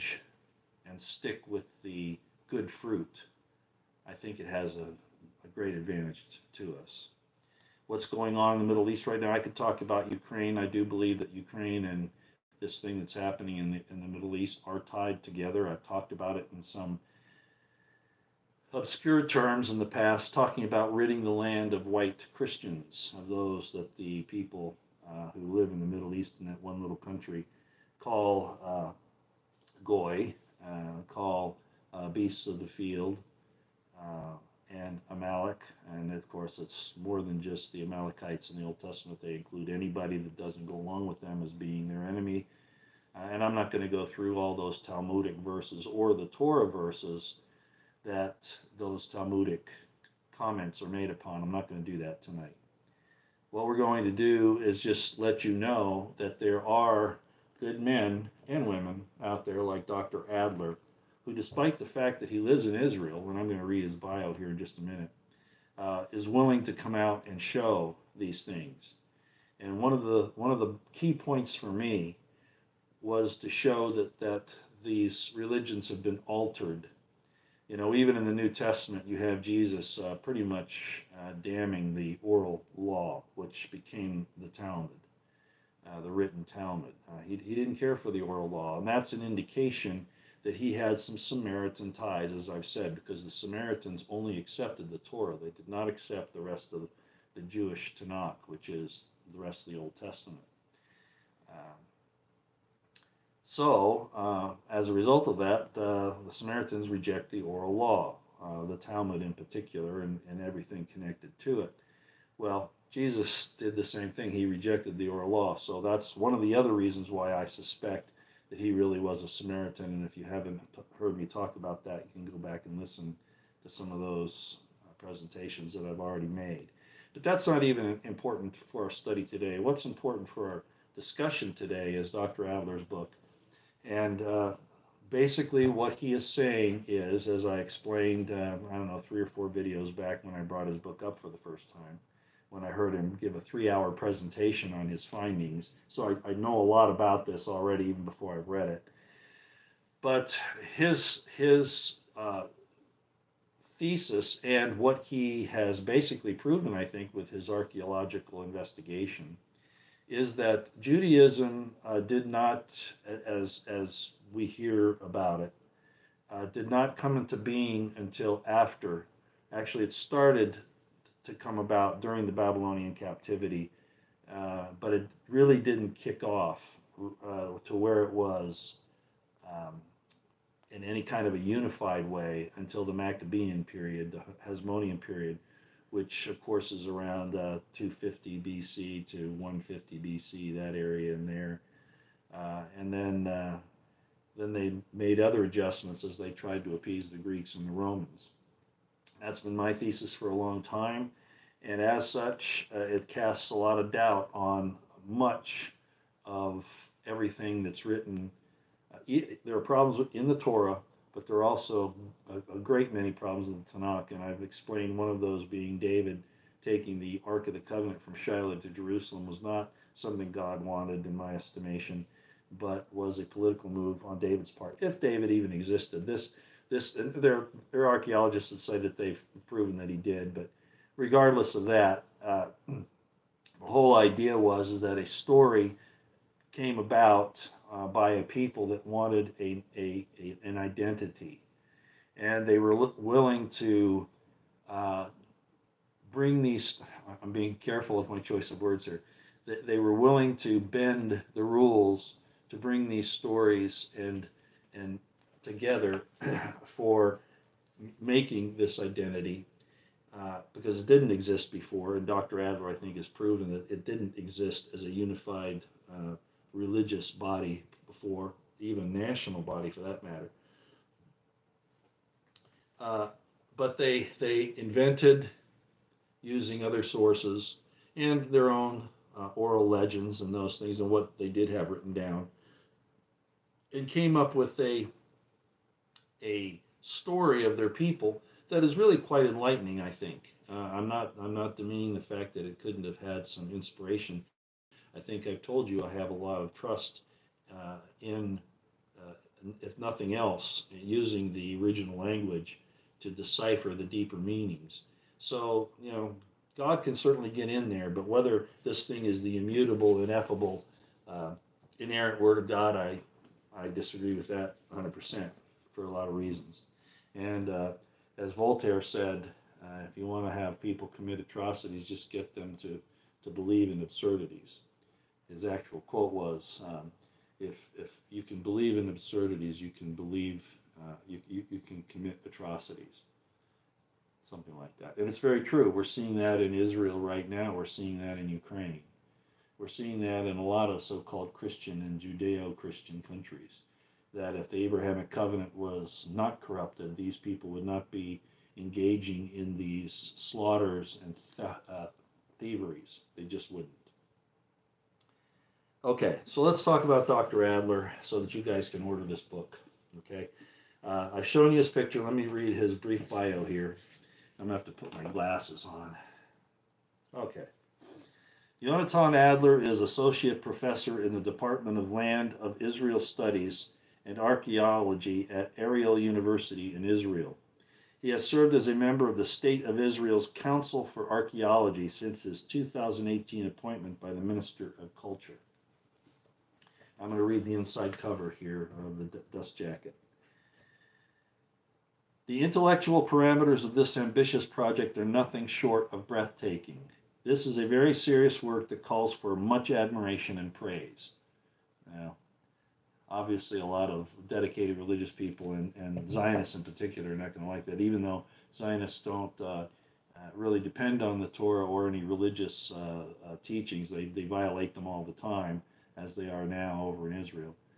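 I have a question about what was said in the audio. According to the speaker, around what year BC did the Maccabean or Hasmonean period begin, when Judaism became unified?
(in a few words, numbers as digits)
250 BC.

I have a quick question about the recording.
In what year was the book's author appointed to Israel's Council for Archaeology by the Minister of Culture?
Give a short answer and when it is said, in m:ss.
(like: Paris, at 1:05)
2018, at 6:22.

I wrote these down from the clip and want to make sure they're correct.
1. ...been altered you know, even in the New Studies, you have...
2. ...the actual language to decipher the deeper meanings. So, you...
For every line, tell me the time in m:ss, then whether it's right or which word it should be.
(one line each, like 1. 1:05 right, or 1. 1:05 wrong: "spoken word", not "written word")
1. 1:16 wrong: "Testament", not "Studies"
2. 5:01 wrong: "original", not "actual".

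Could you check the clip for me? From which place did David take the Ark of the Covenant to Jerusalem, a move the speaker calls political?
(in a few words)
Shiloh.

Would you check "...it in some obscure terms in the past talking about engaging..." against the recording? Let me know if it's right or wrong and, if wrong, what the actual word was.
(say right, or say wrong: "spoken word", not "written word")
wrong: "ridding", not "engaging".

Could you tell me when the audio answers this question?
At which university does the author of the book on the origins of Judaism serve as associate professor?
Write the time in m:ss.
6:15.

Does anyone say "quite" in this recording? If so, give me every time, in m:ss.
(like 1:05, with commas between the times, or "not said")
4:48.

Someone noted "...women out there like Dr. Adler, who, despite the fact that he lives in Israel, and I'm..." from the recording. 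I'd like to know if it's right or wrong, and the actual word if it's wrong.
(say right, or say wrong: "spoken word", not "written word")
right.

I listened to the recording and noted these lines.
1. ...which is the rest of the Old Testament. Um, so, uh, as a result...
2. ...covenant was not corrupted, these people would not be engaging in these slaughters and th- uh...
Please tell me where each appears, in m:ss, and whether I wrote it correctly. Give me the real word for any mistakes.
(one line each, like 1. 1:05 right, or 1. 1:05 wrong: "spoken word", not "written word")
1. 1:38 right
2. 5:45 right.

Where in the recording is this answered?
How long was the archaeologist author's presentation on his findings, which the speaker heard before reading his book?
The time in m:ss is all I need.
2:23.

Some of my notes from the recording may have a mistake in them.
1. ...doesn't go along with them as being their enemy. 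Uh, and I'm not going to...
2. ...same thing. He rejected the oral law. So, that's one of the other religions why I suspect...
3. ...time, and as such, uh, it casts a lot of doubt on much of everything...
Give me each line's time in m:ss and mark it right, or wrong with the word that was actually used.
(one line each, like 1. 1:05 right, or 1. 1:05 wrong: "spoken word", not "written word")
1. 0:40 right
2. 1:53 wrong: "reasons", not "religions"
3. 3:20 right.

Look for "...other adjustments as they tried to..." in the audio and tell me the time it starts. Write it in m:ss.
3:15.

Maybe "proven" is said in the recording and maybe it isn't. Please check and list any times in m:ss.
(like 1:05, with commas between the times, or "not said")
2:36, 3:49, 4:23.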